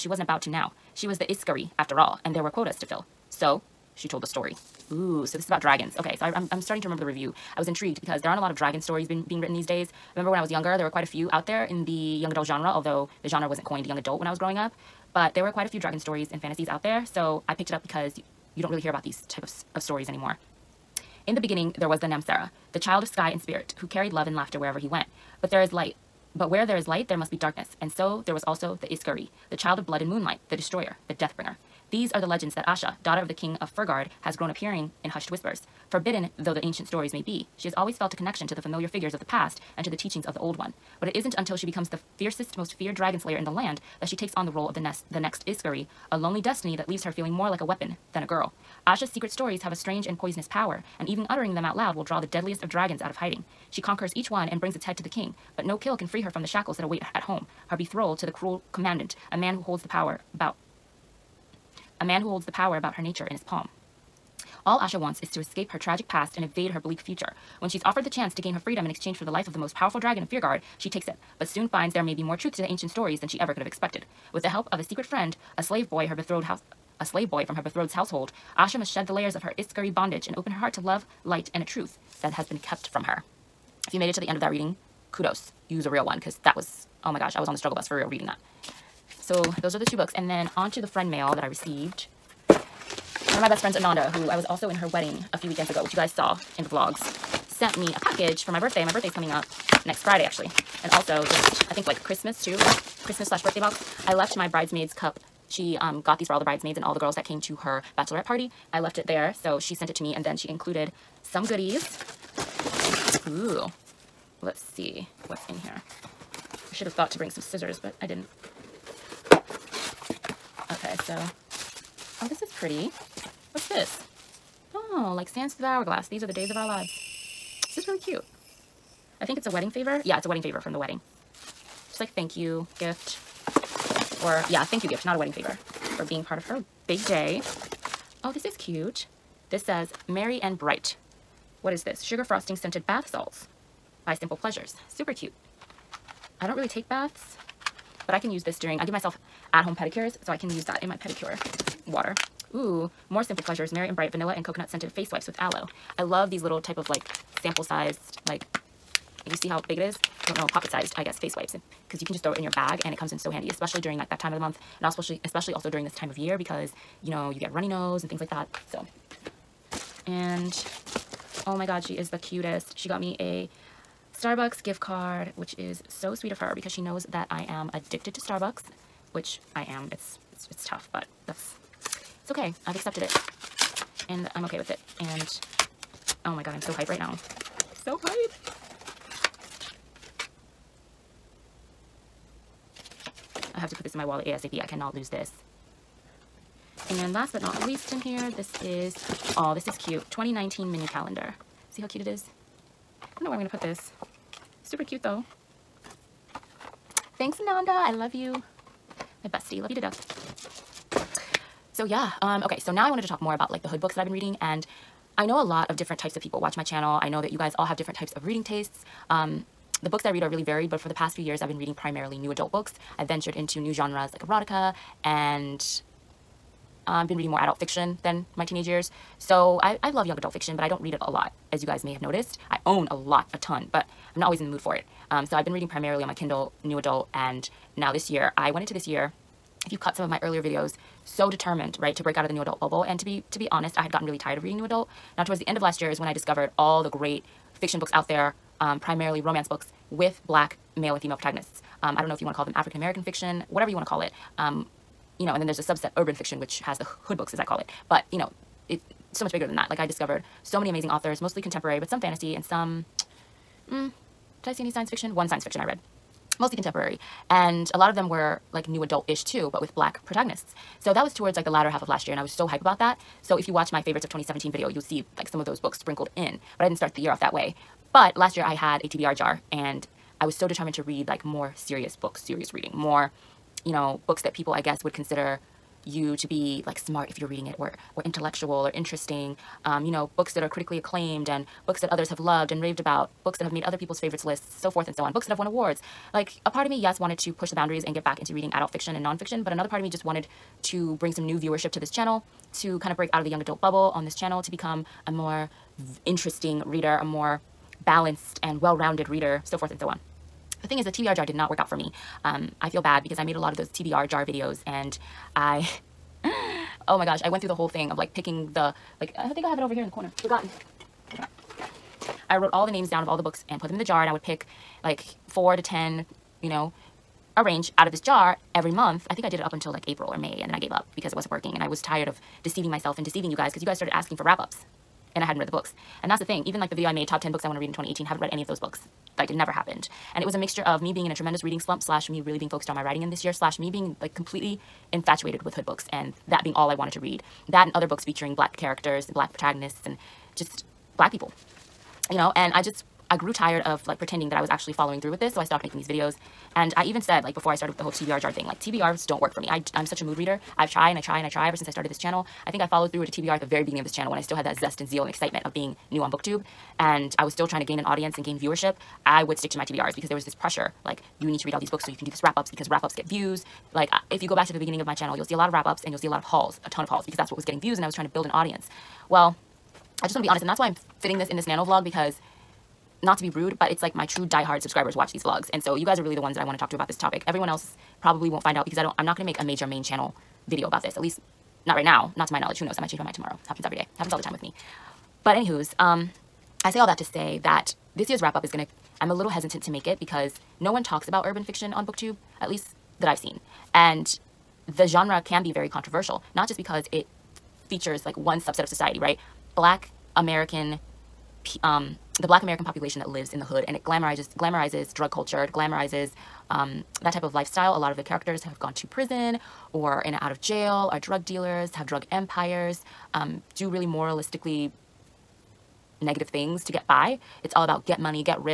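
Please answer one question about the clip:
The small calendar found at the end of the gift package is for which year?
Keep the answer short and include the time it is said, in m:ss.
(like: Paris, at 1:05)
2019, at 3:20.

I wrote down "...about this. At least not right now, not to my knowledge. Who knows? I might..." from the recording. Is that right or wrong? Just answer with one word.
right.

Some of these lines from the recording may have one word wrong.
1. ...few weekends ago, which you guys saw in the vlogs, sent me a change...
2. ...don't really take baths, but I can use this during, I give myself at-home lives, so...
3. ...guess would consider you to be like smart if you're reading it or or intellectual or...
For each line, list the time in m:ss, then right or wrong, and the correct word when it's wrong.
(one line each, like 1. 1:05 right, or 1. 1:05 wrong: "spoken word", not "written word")
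1. 1:35 wrong: "package", not "change"
2. 2:26 wrong: "pedicures", not "lives"
3. 4:44 right.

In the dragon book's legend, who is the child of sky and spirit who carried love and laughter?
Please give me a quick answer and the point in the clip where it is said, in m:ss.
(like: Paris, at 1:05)
Namsara, at 0:22.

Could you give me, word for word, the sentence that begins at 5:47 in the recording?
That and other books featuring black characters and black protagonists and just black people, you know?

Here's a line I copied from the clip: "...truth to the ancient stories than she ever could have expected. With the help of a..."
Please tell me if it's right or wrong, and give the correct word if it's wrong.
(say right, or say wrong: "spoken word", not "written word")
right.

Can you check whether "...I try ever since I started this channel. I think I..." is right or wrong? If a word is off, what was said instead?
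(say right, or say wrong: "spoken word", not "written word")
right.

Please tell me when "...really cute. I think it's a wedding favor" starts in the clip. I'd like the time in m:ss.
2:07.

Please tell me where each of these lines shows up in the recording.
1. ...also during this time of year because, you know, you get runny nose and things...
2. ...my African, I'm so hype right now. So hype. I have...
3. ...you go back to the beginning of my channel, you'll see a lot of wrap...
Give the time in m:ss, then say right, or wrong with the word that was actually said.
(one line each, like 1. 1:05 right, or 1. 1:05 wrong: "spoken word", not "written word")
1. 2:45 right
2. 3:06 wrong: "God", not "African"
3. 6:14 right.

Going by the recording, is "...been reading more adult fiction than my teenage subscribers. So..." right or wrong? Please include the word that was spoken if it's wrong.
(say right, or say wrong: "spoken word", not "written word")
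wrong: "years", not "subscribers".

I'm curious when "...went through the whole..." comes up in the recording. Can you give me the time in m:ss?
5:17.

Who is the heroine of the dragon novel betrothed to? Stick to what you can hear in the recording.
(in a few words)
the cruel commandant.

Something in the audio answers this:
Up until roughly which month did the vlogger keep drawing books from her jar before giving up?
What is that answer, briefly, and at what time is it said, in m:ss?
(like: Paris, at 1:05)
April or May, at 5:29.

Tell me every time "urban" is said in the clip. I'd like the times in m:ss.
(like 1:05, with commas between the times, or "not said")
4:15, 6:41.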